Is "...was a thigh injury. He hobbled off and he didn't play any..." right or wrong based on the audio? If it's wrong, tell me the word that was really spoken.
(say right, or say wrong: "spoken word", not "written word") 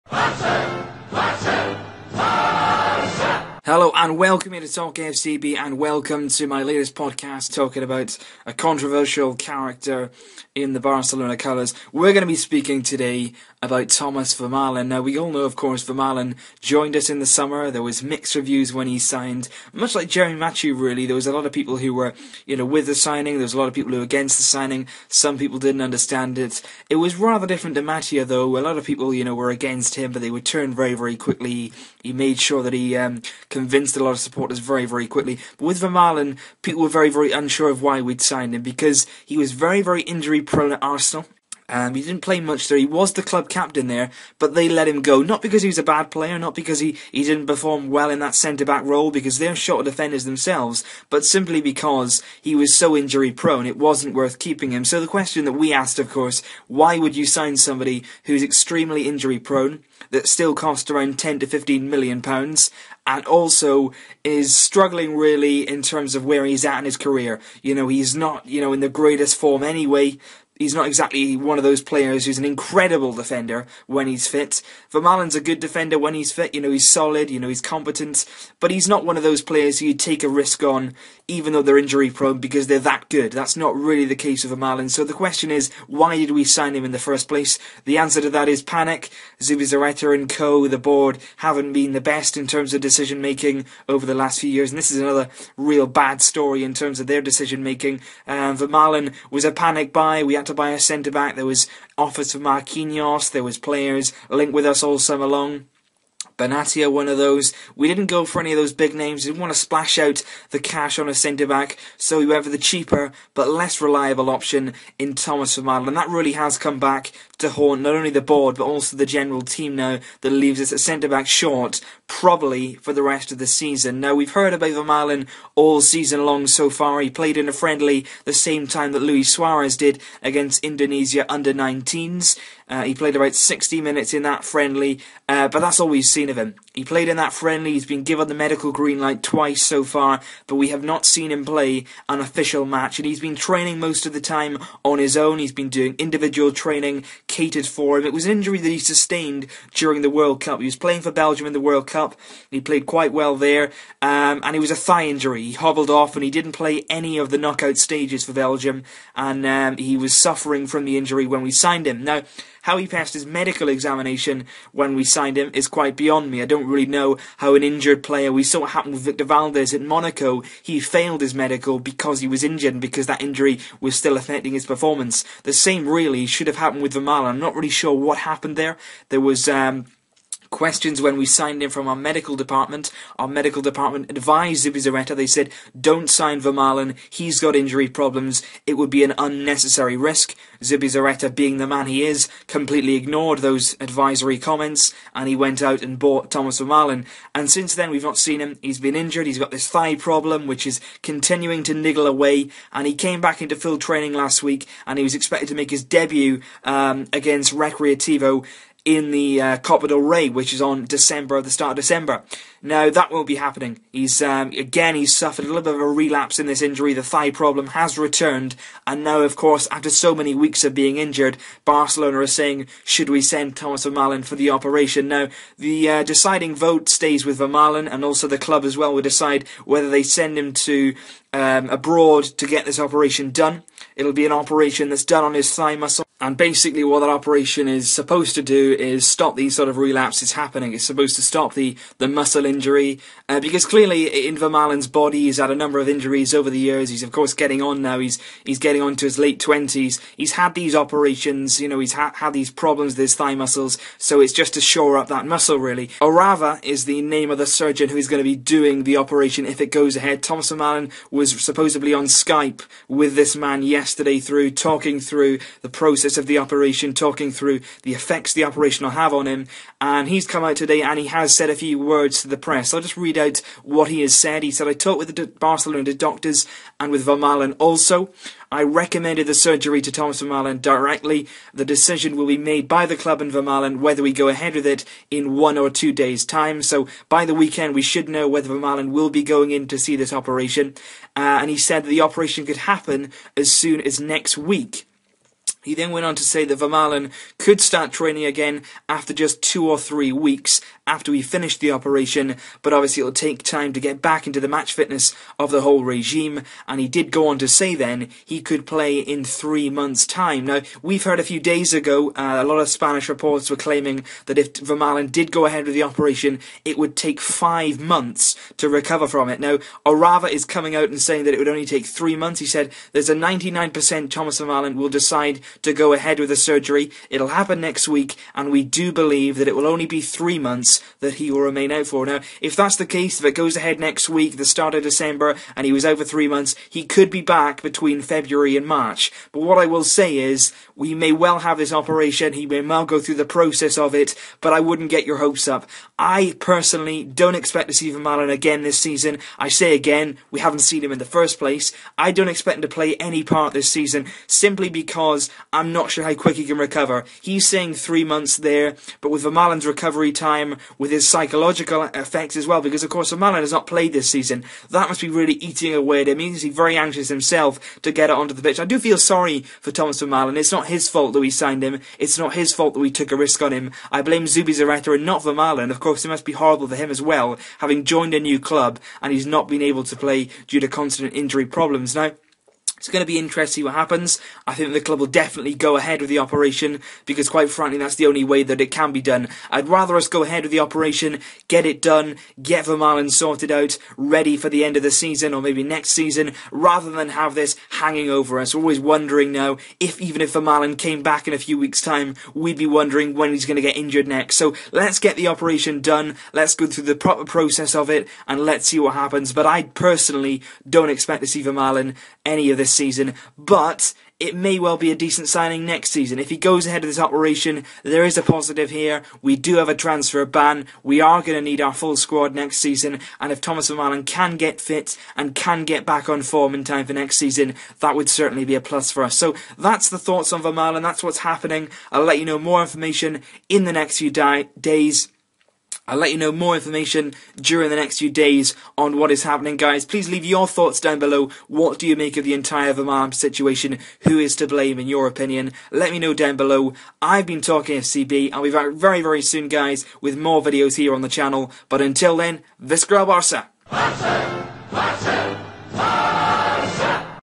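right.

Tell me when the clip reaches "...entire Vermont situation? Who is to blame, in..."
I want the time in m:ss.
7:22.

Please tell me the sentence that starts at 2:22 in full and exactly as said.
And he's been training most of the time on his own, he's been doing individual training catered for him.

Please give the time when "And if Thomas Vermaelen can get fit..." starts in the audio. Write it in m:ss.
7:03.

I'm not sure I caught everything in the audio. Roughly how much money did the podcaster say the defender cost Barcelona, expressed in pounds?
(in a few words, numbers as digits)
£10 to 15 million.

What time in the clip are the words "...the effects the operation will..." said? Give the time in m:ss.
4:27.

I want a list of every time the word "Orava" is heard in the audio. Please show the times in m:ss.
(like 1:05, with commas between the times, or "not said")
4:16, 5:19.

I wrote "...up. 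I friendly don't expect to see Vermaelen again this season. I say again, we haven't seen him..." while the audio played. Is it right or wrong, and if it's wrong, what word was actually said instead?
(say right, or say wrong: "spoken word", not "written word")
wrong: "personally", not "friendly".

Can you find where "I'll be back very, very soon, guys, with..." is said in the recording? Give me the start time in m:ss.
7:28.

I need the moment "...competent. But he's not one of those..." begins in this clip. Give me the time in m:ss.
1:17.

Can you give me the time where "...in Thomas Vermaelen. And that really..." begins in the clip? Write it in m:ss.
1:54.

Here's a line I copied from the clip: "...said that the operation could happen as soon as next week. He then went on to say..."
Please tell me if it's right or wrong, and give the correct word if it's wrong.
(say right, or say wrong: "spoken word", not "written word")
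right.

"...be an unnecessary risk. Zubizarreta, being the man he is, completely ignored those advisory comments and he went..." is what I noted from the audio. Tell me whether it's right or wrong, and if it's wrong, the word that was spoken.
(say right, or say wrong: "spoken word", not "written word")
right.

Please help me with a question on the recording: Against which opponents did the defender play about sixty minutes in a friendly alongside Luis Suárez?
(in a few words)
Indonesia under 19s.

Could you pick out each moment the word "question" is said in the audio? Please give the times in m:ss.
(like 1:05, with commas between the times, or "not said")
0:55, 1:25, 3:00.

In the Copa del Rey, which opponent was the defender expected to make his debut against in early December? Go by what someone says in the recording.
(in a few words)
Recreativo.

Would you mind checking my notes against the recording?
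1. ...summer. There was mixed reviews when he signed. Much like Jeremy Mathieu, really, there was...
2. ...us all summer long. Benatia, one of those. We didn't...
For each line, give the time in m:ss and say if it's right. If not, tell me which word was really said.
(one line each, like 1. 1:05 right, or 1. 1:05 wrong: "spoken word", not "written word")
1. 0:17 right
2. 1:44 right.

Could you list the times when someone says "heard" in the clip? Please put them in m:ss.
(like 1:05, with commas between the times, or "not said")
2:04, 5:11.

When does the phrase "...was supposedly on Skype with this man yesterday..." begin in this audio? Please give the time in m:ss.
4:21.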